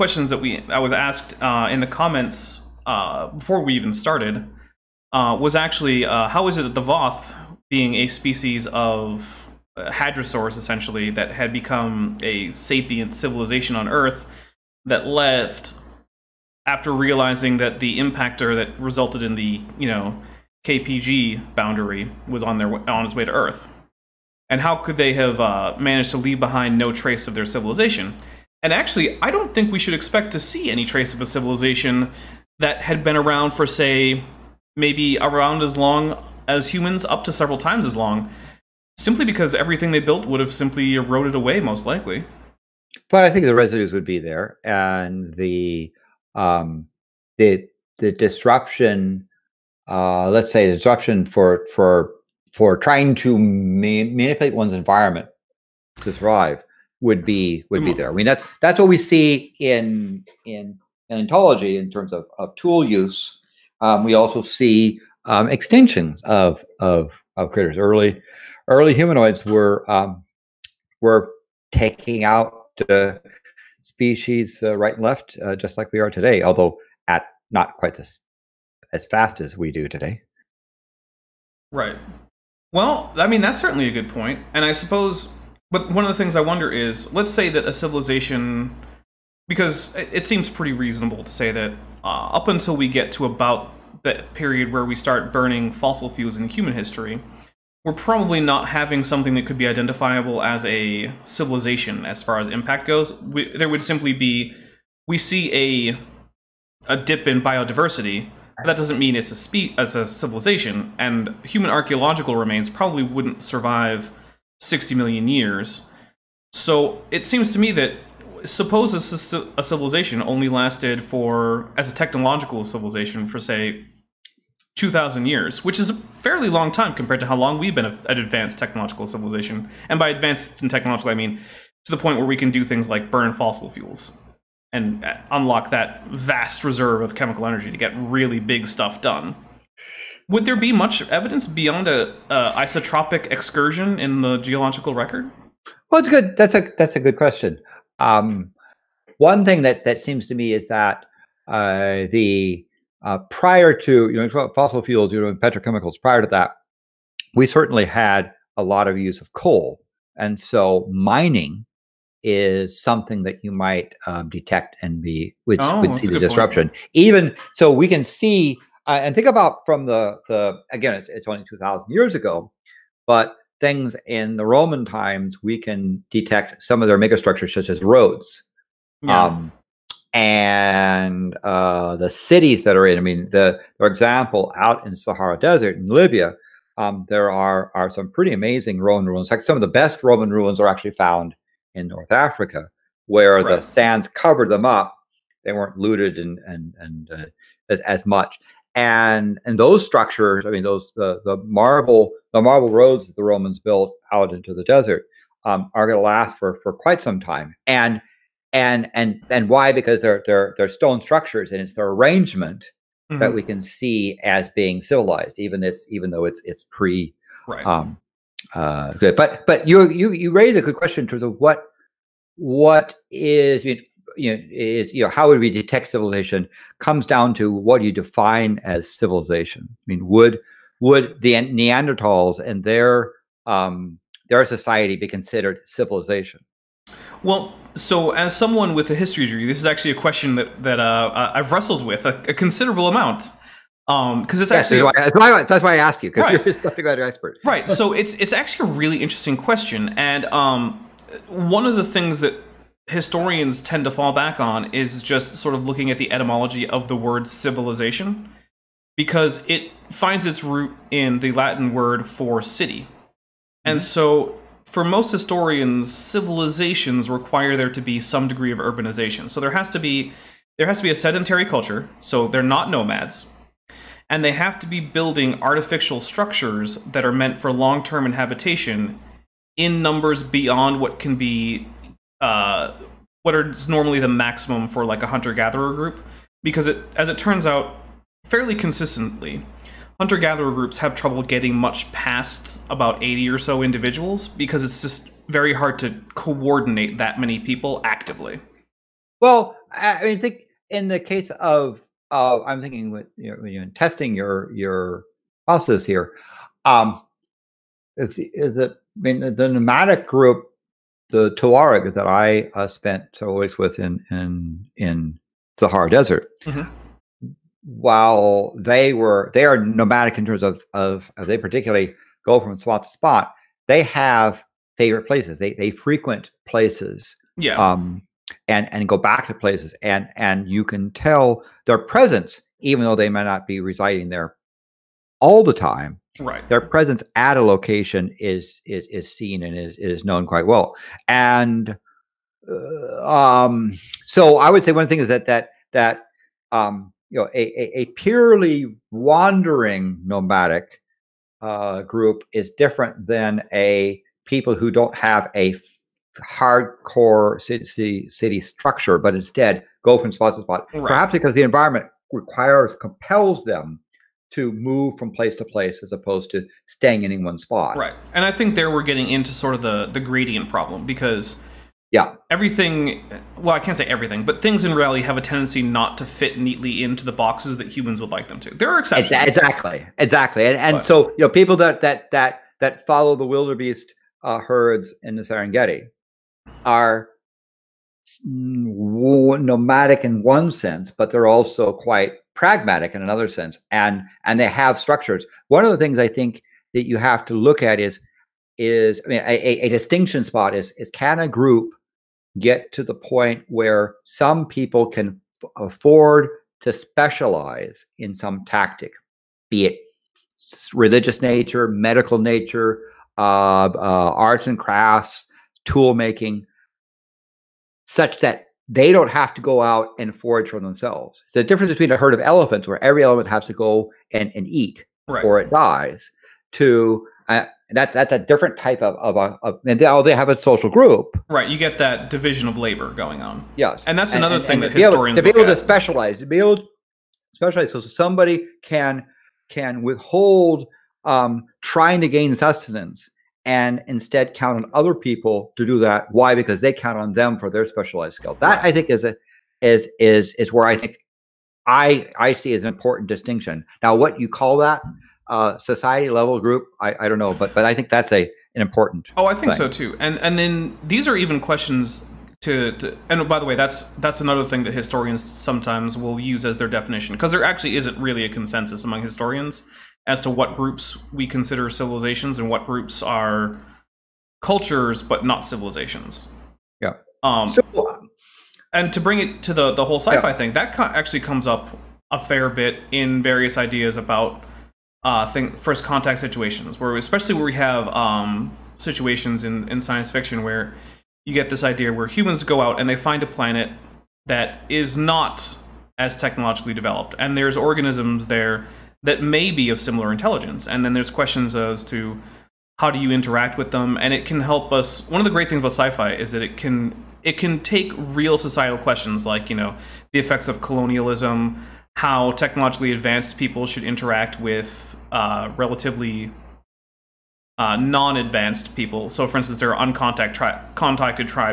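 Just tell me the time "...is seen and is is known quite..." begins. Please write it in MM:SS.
05:38.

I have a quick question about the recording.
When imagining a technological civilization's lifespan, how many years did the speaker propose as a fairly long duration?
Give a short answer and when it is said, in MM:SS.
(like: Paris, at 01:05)
2,000, at 02:04.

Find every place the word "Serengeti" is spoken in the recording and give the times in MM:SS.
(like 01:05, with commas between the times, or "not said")
06:25.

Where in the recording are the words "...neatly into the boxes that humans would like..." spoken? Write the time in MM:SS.
06:16.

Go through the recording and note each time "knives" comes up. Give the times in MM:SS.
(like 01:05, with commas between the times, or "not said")
not said.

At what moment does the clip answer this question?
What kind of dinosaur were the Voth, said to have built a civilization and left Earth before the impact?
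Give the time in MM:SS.
00:09.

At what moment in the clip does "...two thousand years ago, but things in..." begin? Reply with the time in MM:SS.
02:51.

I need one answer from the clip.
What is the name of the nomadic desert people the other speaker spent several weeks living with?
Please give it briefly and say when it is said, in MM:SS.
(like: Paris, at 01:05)
Tuareg, at 05:11.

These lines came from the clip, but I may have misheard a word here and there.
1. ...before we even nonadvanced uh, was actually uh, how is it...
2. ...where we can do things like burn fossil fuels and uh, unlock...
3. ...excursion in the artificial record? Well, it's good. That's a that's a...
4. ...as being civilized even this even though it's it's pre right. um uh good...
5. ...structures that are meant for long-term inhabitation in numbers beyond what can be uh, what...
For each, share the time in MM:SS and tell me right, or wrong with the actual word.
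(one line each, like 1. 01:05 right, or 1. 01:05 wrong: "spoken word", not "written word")
1. 00:03 wrong: "started", not "nonadvanced"
2. 02:12 right
3. 02:23 wrong: "geological", not "artificial"
4. 03:34 right
5. 04:36 right.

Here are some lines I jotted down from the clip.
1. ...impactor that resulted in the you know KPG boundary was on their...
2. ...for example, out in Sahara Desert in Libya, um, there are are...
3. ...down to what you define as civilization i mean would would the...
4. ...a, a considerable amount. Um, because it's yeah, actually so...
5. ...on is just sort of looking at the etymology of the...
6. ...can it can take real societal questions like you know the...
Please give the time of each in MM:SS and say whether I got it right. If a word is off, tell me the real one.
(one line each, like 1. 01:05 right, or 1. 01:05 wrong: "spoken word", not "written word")
1. 00:17 right
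2. 03:03 right
3. 03:47 right
4. 04:02 right
5. 04:14 right
6. 08:26 right.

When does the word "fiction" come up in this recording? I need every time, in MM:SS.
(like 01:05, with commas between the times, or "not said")
08:10.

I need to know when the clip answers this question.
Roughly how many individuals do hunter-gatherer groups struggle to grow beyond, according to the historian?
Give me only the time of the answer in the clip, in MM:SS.
04:53.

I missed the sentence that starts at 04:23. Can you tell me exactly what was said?
so for most historians, civilizations require there to be some degree of urbanization.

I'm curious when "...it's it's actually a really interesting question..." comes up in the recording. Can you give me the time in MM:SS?
04:07.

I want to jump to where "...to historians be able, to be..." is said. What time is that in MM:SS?
07:14.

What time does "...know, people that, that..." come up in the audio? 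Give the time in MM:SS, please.
06:21.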